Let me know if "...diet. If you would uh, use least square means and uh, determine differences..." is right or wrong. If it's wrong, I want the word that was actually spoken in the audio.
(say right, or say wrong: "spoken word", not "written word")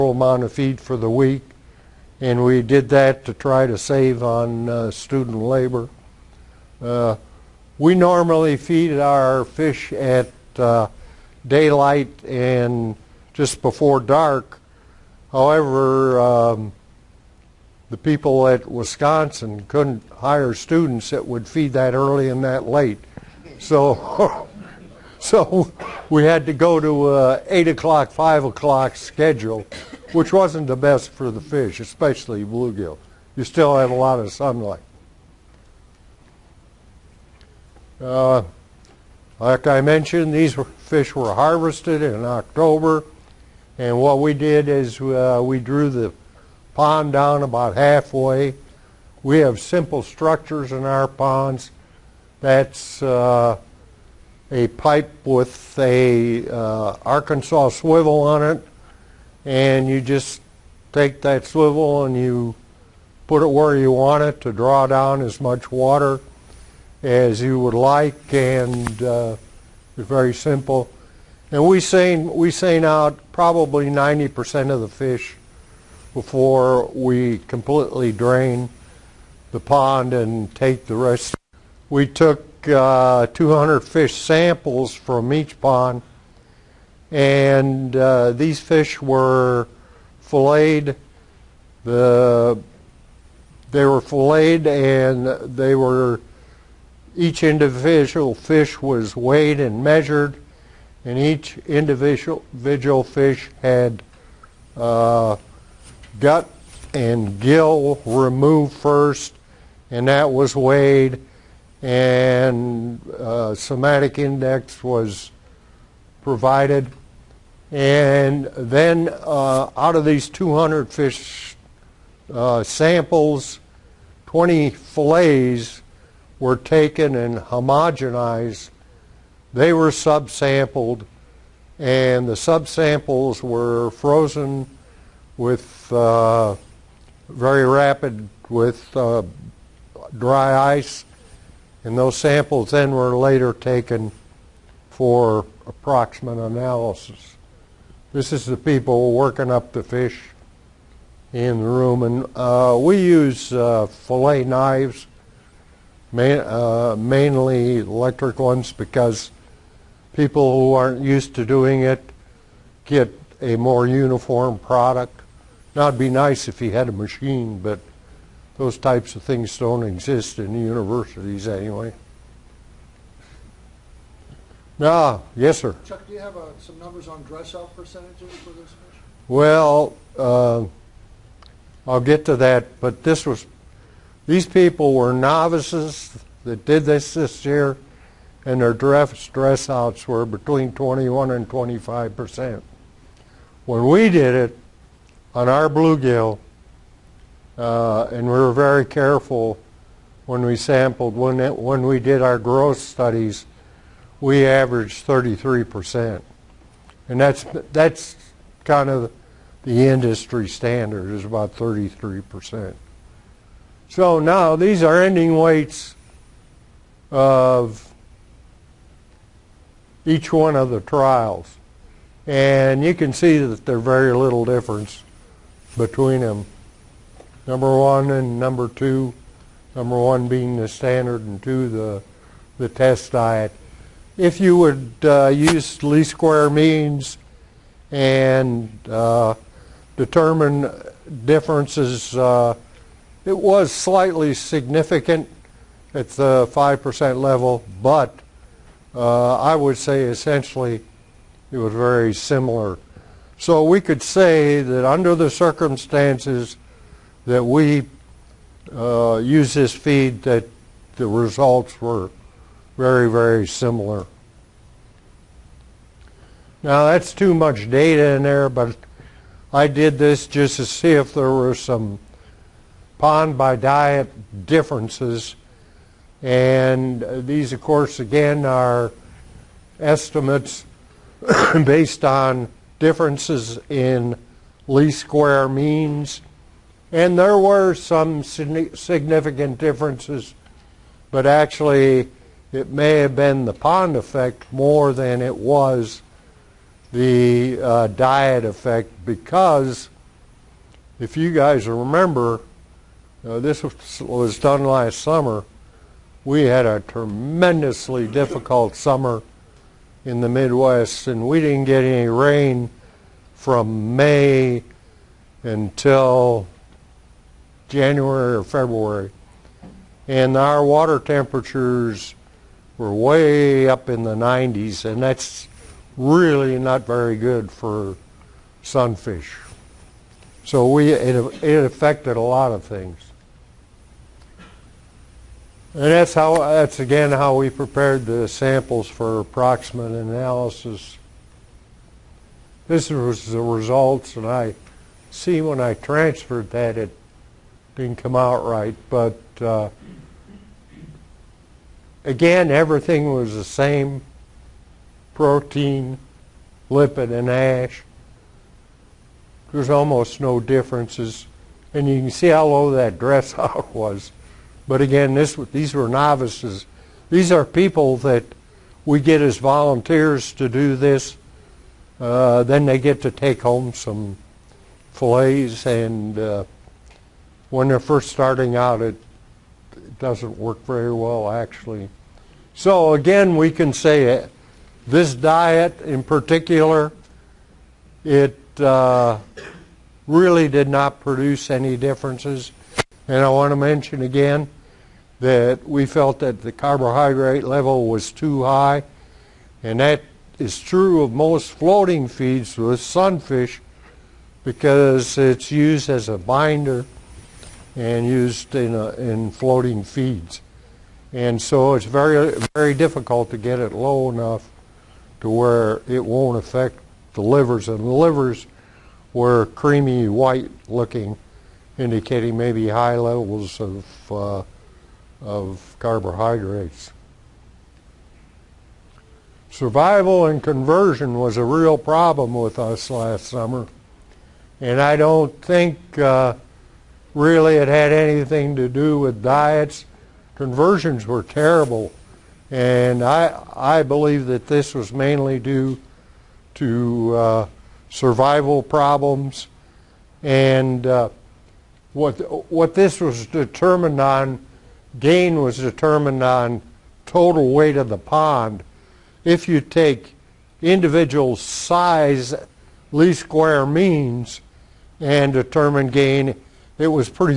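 right.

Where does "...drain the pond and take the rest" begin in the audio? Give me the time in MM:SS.
01:18.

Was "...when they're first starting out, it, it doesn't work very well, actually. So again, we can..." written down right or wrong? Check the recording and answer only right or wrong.
right.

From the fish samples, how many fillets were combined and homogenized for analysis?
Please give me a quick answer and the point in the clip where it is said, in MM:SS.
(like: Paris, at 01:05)
20, at 02:04.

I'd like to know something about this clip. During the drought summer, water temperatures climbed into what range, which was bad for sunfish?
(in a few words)
the 90s.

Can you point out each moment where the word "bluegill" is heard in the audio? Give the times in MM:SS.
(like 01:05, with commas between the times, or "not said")
00:32, 03:15.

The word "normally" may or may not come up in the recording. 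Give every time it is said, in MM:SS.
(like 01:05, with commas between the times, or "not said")
00:07.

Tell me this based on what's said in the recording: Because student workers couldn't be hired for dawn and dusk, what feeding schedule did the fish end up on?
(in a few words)
8 o'clock, 5 o'clock.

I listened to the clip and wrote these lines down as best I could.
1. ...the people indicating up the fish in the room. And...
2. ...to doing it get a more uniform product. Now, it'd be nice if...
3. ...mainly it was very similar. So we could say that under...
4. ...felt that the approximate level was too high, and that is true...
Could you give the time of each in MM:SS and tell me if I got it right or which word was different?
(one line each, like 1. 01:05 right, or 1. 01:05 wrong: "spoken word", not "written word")
1. 02:28 wrong: "working", not "indicating"
2. 02:41 right
3. 04:10 wrong: "essentially", not "mainly"
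4. 06:35 wrong: "carbohydrate", not "approximate".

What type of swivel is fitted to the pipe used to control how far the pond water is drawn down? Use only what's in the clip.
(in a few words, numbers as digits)
Arkansas swivel.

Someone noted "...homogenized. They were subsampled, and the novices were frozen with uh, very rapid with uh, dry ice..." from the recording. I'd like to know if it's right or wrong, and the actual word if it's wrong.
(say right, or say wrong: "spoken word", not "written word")
wrong: "subsamples", not "novices".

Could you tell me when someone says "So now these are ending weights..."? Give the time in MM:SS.
03:33.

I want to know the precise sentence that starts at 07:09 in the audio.
Survival and conversion was a real problem with us last summer.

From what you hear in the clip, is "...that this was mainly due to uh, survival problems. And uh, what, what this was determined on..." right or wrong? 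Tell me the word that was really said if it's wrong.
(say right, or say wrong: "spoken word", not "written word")
right.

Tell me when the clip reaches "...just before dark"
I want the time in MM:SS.
00:13.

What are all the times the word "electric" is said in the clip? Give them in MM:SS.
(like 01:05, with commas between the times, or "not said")
02:37.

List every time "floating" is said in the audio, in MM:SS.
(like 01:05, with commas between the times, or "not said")
06:41, 06:49.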